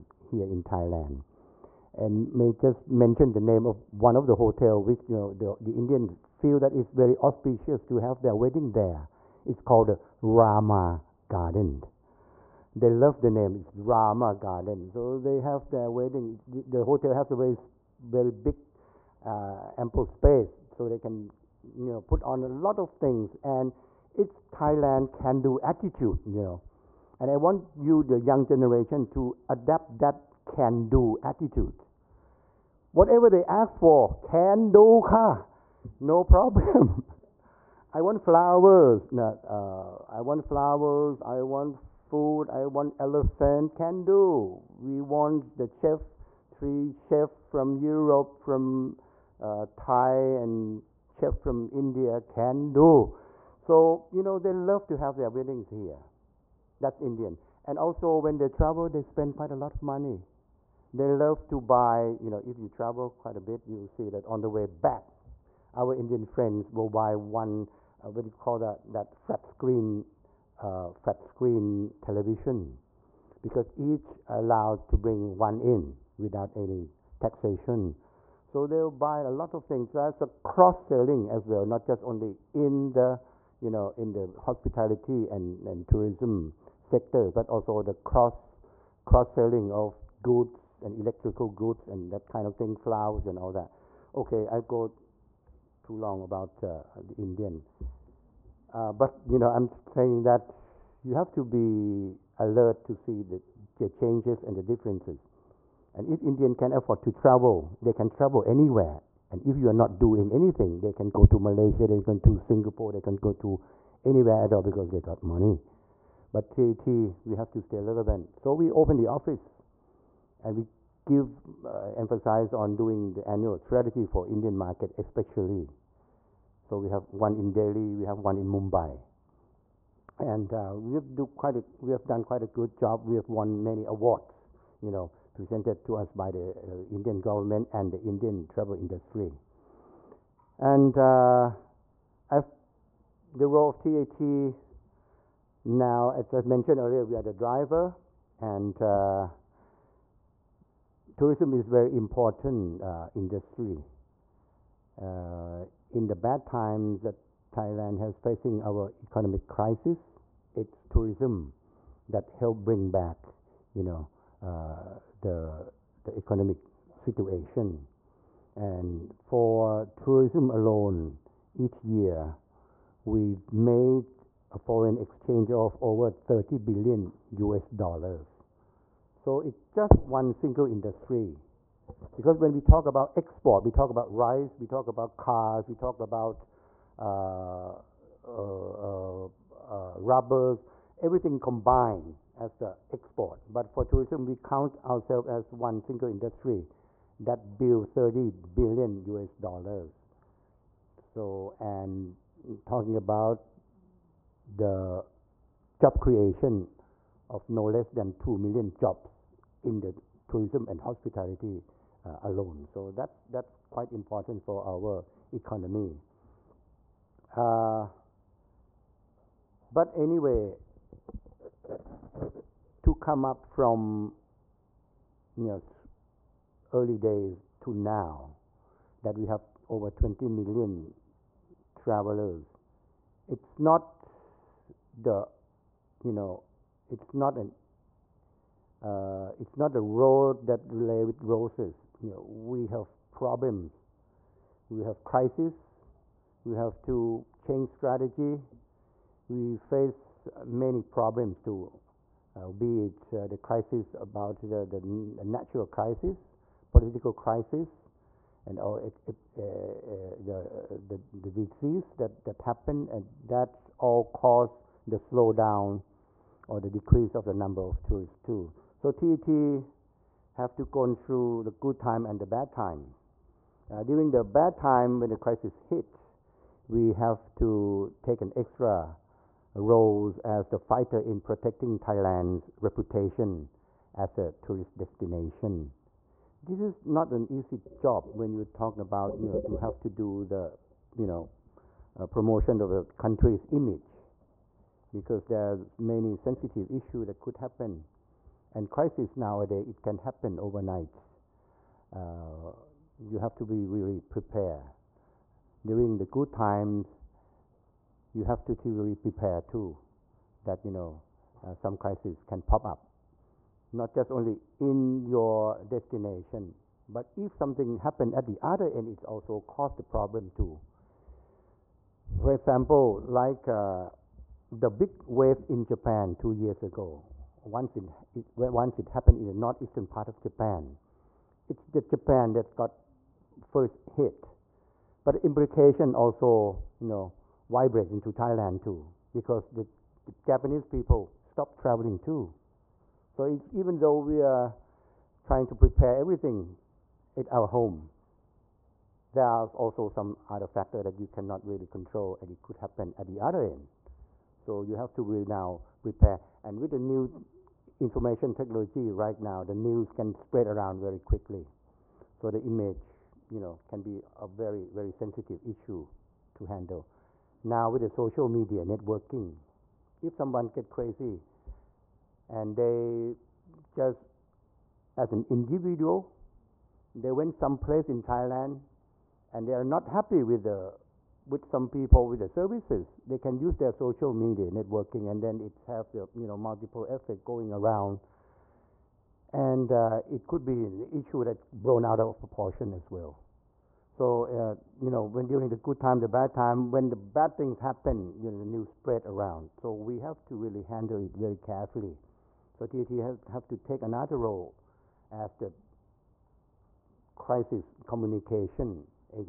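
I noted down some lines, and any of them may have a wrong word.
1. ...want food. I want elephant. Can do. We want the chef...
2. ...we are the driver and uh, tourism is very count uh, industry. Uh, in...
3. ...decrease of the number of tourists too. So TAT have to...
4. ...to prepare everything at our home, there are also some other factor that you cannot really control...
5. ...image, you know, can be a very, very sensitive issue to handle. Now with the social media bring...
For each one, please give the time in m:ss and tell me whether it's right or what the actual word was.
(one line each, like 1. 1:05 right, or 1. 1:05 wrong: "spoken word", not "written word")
1. 0:41 right
2. 2:27 wrong: "important", not "count"
3. 4:26 right
4. 5:45 right
5. 6:02 wrong: "networking", not "bring".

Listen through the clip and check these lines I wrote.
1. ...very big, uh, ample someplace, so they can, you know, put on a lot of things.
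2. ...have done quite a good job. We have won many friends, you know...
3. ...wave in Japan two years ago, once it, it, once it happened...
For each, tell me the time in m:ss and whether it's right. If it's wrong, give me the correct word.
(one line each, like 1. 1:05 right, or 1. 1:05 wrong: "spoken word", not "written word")
1. 0:18 wrong: "space", not "someplace"
2. 2:11 wrong: "awards", not "friends"
3. 5:25 right.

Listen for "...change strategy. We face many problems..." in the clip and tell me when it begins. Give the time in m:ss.
4:07.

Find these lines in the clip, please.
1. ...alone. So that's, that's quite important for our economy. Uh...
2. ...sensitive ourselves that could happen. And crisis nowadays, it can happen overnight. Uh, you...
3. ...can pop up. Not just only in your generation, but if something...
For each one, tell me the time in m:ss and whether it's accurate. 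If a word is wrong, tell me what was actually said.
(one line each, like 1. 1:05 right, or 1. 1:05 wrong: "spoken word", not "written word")
1. 3:32 right
2. 4:56 wrong: "issues", not "ourselves"
3. 5:12 wrong: "destination", not "generation".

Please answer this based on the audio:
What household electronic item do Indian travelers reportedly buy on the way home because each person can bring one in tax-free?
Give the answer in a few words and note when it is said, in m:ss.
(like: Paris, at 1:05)
flat screen television, at 1:10.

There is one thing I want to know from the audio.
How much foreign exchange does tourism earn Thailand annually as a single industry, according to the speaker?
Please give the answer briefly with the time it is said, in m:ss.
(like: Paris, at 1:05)
over $30 billion, at 2:55.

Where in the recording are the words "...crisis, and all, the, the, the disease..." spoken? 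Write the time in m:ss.
4:17.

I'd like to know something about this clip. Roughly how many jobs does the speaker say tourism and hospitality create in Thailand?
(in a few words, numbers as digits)
2 million.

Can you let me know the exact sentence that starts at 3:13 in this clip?
But for tourism, we count ourselves as one single industry that builds 30 billion US dollars.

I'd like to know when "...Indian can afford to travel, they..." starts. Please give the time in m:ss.
1:46.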